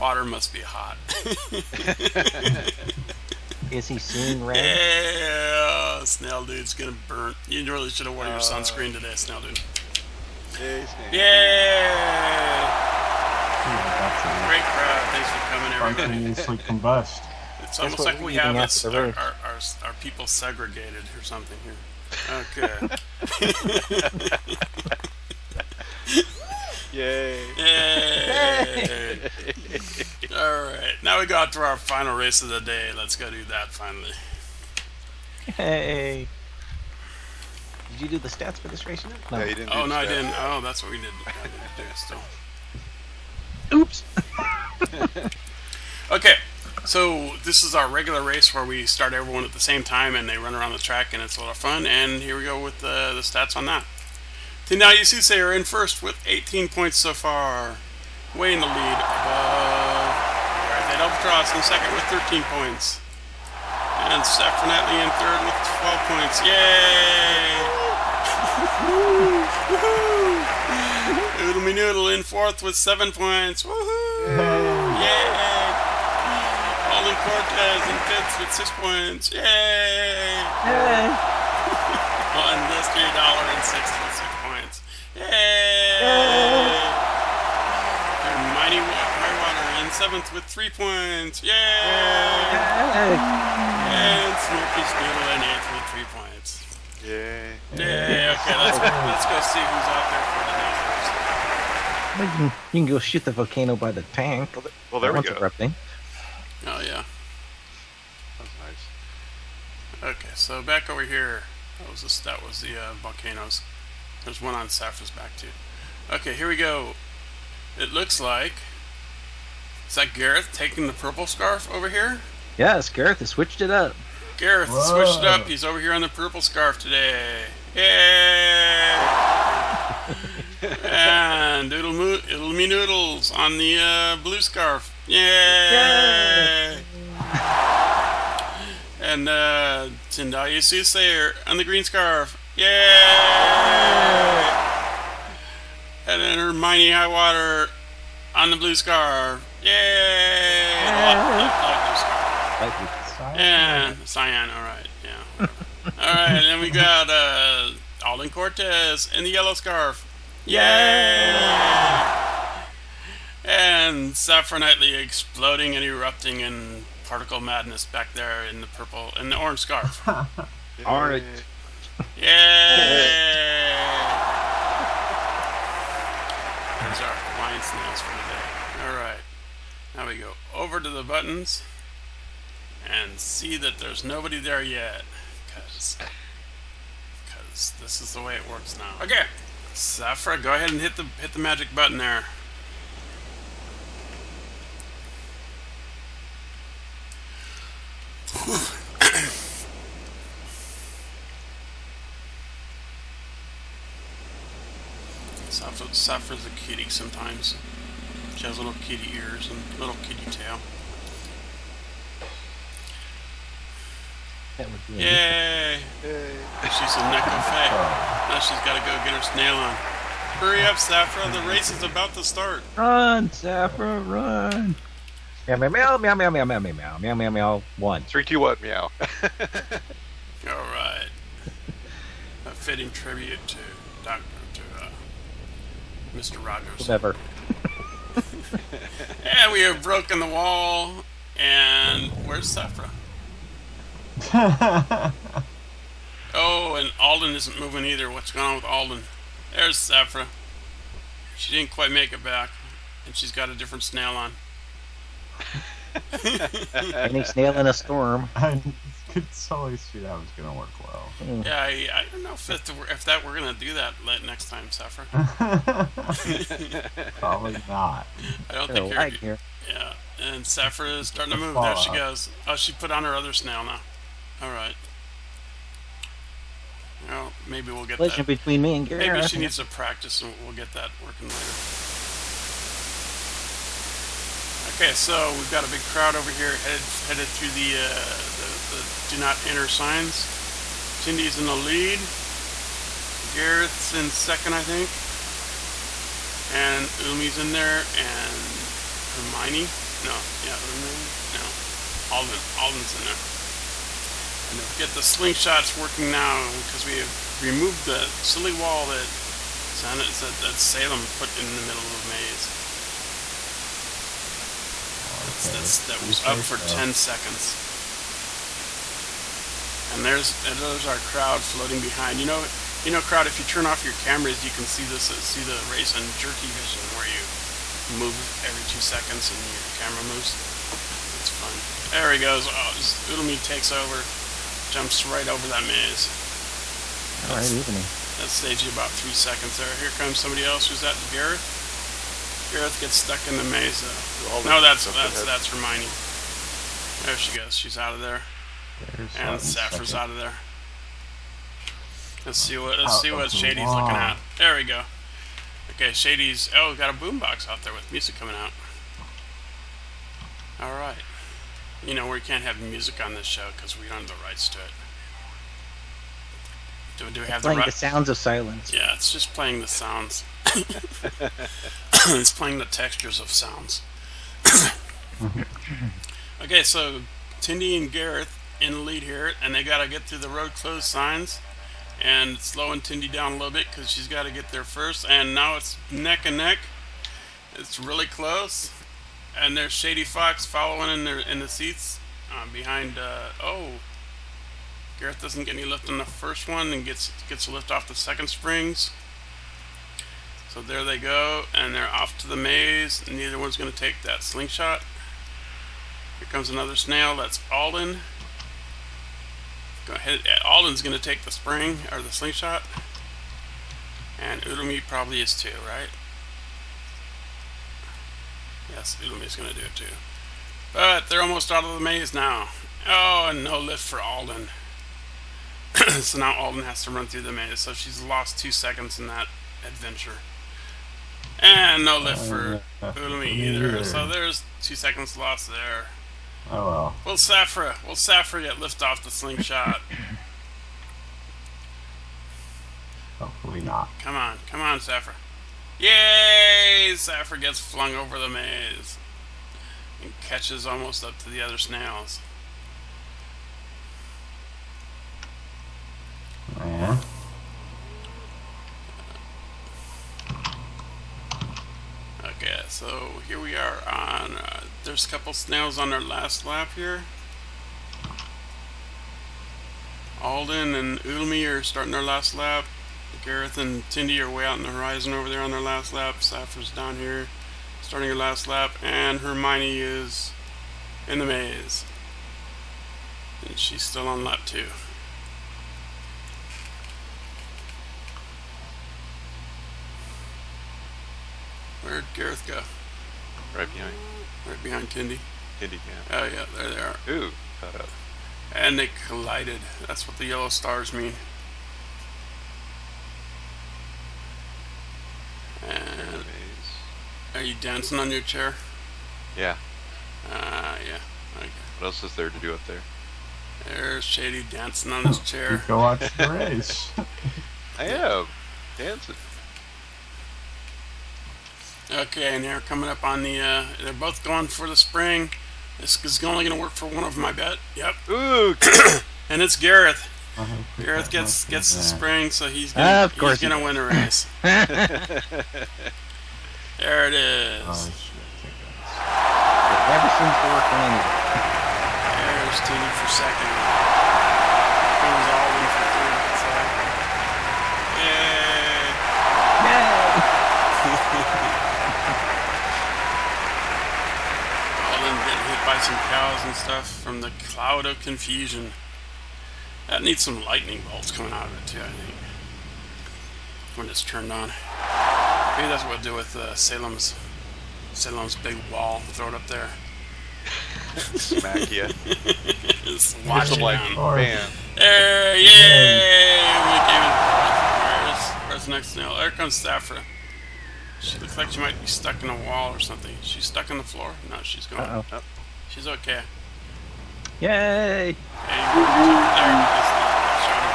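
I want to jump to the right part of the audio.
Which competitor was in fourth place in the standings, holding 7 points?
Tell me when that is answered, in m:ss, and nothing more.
1:11.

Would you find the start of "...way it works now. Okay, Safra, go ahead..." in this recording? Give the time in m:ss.
3:08.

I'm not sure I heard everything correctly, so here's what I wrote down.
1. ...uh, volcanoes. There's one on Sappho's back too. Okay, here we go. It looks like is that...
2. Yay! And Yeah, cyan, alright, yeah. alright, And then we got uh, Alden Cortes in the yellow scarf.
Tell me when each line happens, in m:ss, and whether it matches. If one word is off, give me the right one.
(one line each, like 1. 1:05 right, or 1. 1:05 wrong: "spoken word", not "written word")
1. 1:52 right
2. 2:29 right.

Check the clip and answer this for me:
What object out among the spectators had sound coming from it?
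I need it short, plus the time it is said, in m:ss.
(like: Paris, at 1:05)
A boombox, at 5:56.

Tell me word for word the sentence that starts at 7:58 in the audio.
And Hermione is in the maze.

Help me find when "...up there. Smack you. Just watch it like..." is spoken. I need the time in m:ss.
9:29.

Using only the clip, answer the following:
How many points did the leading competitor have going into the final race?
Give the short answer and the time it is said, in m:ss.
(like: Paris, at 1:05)
18, at 0:56.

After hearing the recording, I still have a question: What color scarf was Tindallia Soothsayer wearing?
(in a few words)
Green.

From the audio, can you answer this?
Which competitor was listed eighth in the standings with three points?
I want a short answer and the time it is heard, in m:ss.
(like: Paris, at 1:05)
Smoky Snoodle, at 1:34.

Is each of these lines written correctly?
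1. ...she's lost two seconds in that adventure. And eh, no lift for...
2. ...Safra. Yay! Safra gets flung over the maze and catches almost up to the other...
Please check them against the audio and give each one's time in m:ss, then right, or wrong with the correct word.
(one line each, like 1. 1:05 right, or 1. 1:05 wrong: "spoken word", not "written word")
1. 7:07 right
2. 7:24 right.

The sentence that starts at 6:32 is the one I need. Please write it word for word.
Uh, oh, Gareth doesn't get any lift on the first one, and gets gets a lift off the second springs.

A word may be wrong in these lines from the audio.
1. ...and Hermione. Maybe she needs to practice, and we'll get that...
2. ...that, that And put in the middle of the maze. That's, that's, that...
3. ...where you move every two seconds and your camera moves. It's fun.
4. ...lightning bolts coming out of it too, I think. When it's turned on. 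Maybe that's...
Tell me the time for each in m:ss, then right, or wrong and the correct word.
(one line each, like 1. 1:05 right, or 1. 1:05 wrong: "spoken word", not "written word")
1. 4:38 wrong: "Gary", not "Hermione"
2. 5:09 wrong: "Salem", not "And"
3. 5:26 right
4. 9:20 right.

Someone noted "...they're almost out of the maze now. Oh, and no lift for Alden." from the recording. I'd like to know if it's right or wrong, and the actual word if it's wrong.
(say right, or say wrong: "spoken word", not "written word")
right.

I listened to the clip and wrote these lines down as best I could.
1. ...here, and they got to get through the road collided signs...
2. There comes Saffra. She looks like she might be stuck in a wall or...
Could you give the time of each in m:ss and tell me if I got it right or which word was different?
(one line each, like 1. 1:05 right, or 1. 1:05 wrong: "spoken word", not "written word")
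1. 6:19 wrong: "closed", not "collided"
2. 9:39 right.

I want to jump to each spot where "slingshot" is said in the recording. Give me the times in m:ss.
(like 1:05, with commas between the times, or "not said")
5:05, 6:44, 6:52, 7:19.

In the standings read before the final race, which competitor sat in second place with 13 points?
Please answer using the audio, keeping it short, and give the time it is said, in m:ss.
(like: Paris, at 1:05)
Red Albatros, at 1:00.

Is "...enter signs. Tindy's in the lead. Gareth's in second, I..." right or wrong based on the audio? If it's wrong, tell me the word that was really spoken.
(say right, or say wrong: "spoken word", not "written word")
right.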